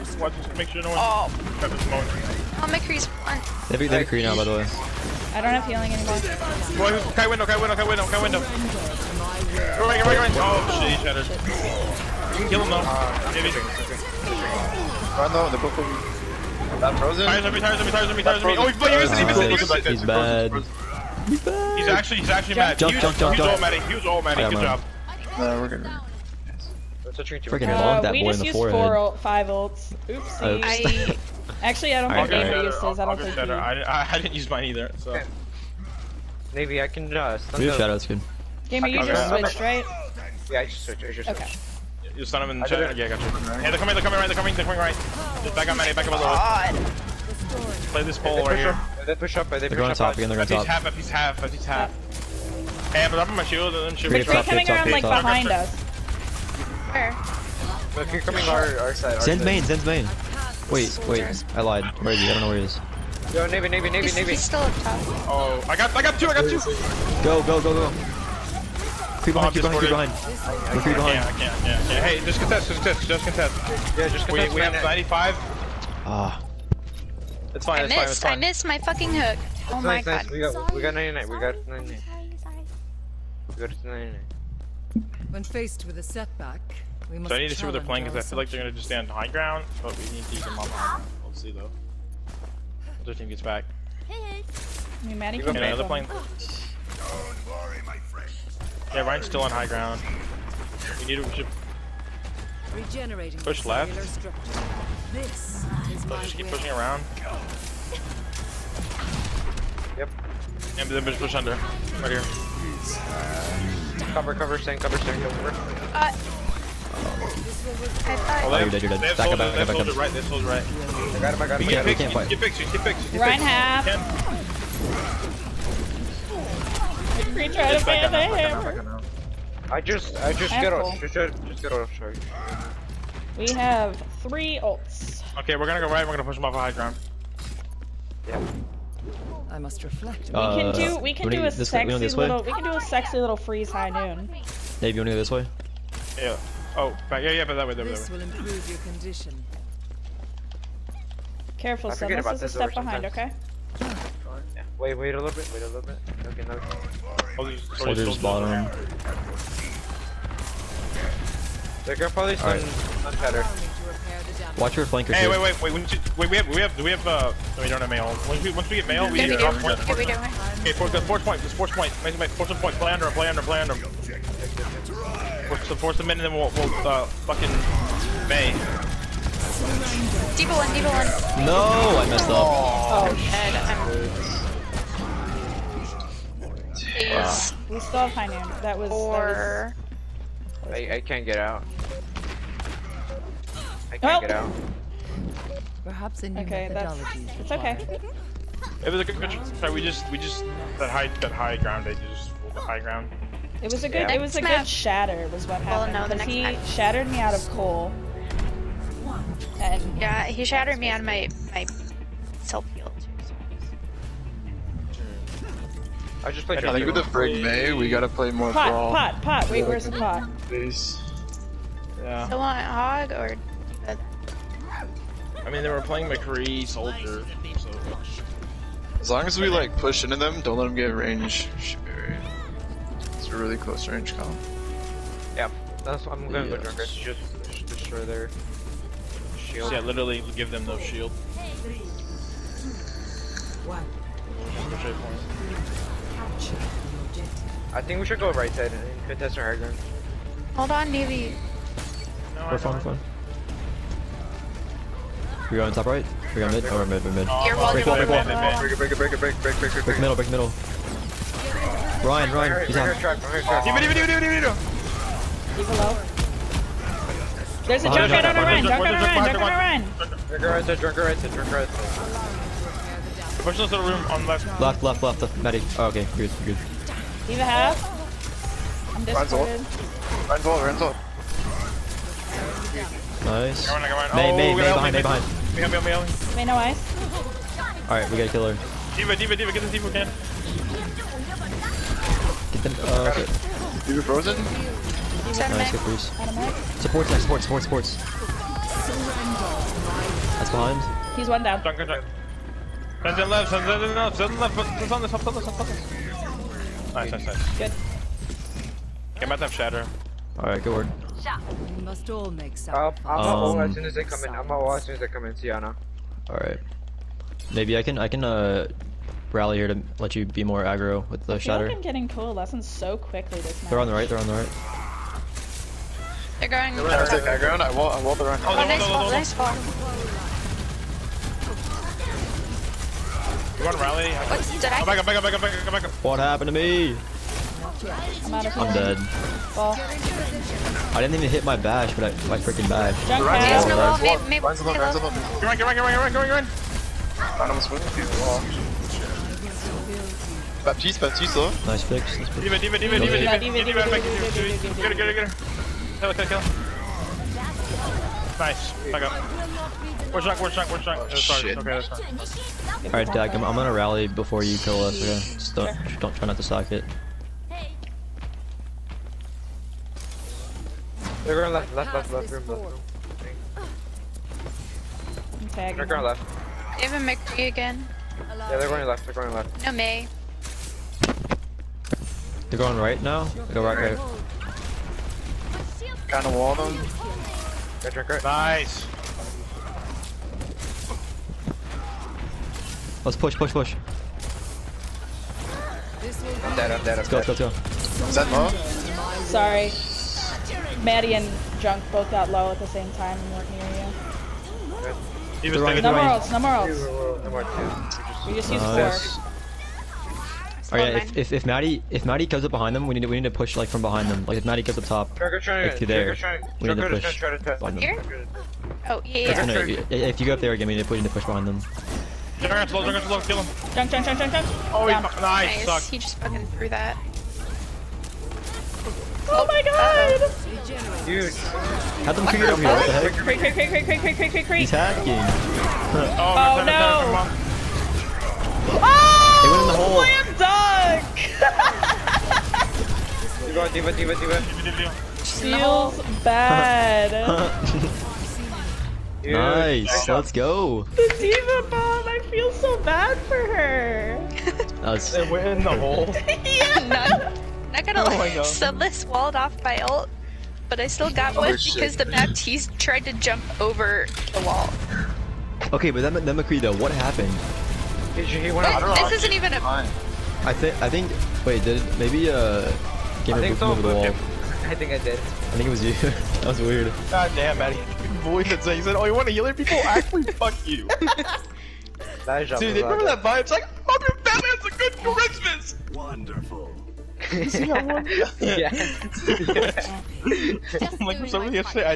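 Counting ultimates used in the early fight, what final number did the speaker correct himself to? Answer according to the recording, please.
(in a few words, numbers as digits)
5.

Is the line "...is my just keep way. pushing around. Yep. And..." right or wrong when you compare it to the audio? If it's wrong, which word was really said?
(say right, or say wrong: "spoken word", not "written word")
right.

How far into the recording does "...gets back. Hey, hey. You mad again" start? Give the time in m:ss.
1:33.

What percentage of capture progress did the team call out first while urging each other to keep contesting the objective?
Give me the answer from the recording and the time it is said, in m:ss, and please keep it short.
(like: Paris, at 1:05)
95, at 1:14.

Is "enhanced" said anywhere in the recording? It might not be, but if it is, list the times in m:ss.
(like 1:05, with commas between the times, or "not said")
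not said.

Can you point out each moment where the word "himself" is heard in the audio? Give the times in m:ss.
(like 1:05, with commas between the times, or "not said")
not said.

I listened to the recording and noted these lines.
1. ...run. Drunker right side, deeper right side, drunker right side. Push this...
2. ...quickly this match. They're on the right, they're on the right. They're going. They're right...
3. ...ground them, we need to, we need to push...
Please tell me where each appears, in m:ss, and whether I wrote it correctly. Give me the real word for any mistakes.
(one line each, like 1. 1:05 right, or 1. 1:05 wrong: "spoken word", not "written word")
1. 4:29 wrong: "drunker", not "deeper"
2. 5:22 right
3. 6:52 wrong: "behind", not "ground".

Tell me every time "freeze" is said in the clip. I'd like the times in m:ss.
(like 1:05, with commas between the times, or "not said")
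2:23, 4:55.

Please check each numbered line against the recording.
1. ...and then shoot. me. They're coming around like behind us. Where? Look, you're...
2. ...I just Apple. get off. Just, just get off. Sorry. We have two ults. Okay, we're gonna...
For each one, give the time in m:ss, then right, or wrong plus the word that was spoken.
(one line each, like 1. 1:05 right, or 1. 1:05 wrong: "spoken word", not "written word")
1. 0:53 right
2. 2:10 wrong: "three", not "two".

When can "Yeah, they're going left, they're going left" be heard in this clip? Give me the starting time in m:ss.
6:18.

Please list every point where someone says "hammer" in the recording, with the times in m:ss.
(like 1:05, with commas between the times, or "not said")
2:08.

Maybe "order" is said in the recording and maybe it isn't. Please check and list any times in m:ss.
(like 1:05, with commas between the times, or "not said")
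not said.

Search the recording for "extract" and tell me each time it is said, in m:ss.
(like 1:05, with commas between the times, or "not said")
not said.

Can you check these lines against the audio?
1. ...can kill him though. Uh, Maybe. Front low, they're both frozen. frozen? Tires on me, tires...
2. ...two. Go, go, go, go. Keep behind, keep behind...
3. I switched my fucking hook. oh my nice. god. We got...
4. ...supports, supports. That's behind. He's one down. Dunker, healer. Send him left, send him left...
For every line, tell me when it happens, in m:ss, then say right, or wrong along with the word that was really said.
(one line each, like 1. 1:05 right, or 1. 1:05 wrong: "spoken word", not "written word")
1. 0:12 right
2. 1:06 right
3. 1:18 wrong: "missed", not "switched"
4. 4:57 wrong: "dunker", not "healer".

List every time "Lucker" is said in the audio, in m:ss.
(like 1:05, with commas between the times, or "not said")
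not said.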